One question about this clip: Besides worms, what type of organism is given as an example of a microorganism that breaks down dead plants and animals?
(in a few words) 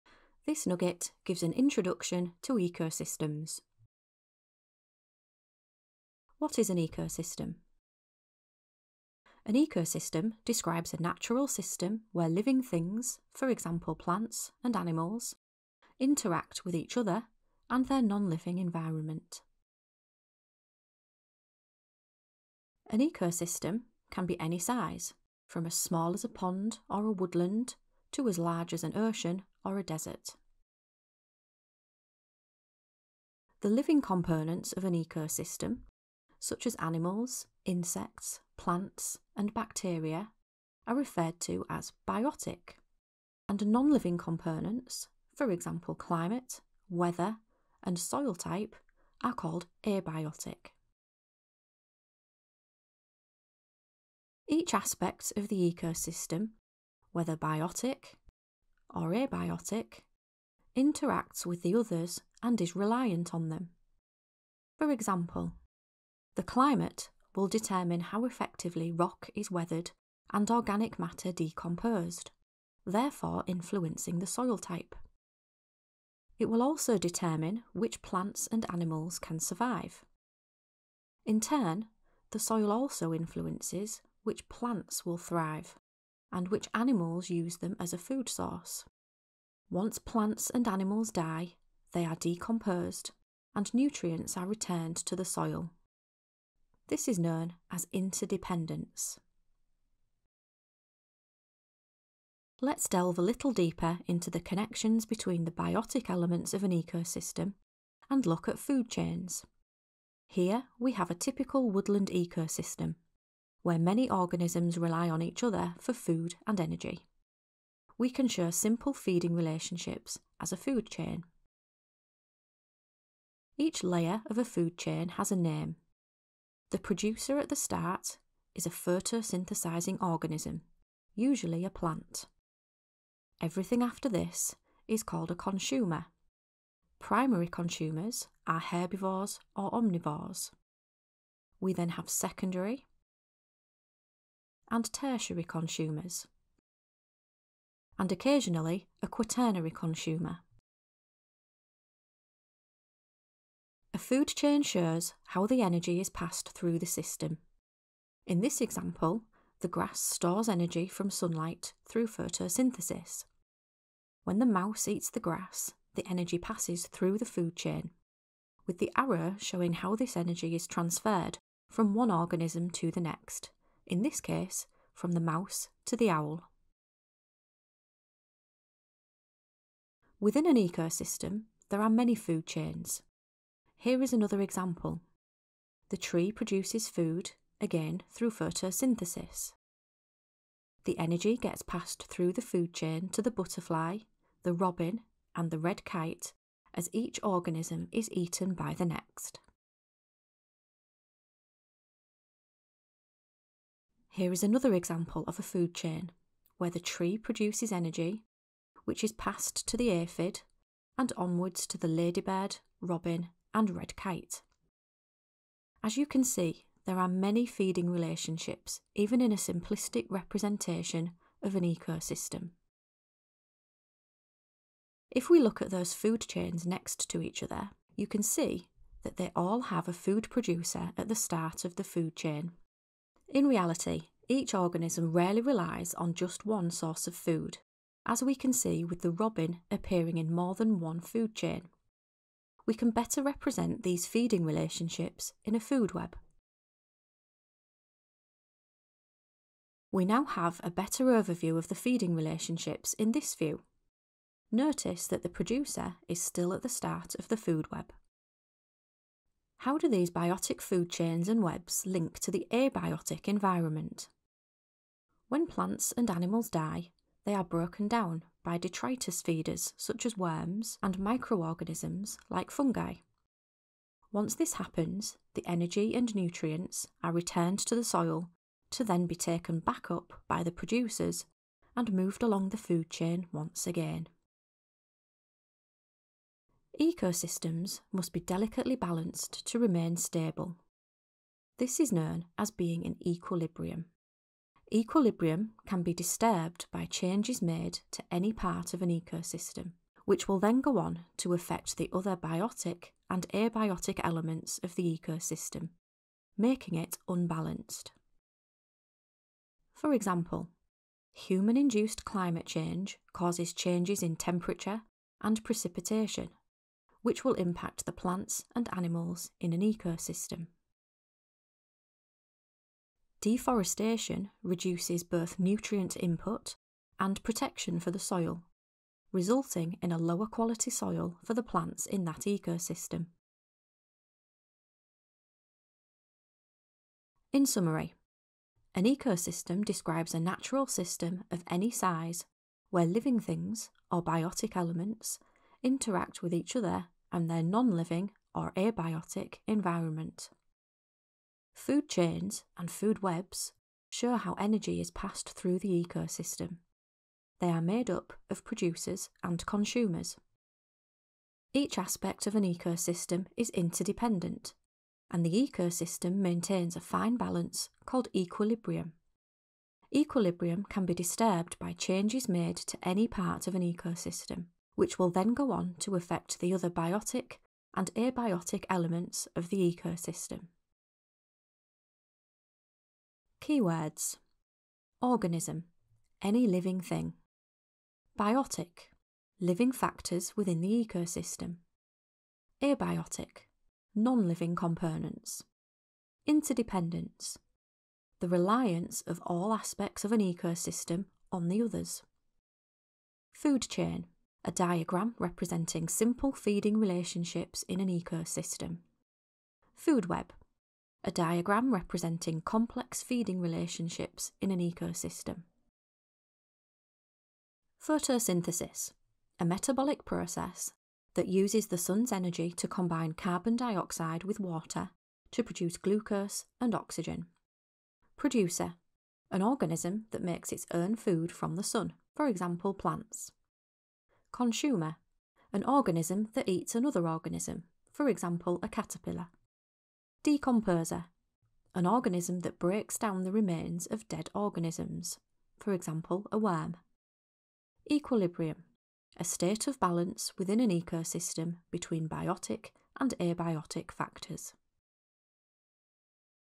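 Fungi.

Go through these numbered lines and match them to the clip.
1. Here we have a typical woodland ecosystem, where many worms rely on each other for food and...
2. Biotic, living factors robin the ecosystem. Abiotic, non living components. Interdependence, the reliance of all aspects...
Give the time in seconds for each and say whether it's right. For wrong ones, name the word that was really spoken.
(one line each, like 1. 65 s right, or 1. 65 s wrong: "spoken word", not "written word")
1. 110 s wrong: "organisms", not "worms"
2. 388 s wrong: "within", not "robin".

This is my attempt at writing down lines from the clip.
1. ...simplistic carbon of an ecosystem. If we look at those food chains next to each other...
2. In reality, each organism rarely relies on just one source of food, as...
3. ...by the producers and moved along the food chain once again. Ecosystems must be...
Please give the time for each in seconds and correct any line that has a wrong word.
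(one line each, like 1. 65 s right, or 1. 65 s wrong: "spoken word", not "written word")
1. 219 s wrong: "representation", not "carbon"
2. 233 s right
3. 280 s right.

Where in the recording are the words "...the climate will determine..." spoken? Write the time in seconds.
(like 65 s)
66 s.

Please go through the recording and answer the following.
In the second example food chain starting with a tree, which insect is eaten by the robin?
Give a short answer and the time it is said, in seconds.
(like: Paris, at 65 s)
Butterfly, at 193 s.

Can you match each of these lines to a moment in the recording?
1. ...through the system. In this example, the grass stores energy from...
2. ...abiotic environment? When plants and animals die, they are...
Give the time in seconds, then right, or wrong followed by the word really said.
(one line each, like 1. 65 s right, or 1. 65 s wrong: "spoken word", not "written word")
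1. 156 s right
2. 262 s right.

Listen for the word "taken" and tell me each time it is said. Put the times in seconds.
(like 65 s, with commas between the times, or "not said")
279 s.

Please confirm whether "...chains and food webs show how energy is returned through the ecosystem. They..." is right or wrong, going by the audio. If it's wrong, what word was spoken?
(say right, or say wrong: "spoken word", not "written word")
wrong: "passed", not "returned".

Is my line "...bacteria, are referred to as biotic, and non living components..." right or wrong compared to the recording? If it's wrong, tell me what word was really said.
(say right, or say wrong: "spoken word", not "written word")
right.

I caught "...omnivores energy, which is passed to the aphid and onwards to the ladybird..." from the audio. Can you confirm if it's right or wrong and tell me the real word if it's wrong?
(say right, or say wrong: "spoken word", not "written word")
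wrong: "produces", not "omnivores".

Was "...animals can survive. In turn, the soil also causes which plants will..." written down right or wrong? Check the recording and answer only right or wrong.
wrong.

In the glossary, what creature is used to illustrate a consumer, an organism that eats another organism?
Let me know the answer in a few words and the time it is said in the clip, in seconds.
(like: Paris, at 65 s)
Caterpillar, at 438 s.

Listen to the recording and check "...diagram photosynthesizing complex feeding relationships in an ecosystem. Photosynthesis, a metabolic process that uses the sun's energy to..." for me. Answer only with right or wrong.
wrong.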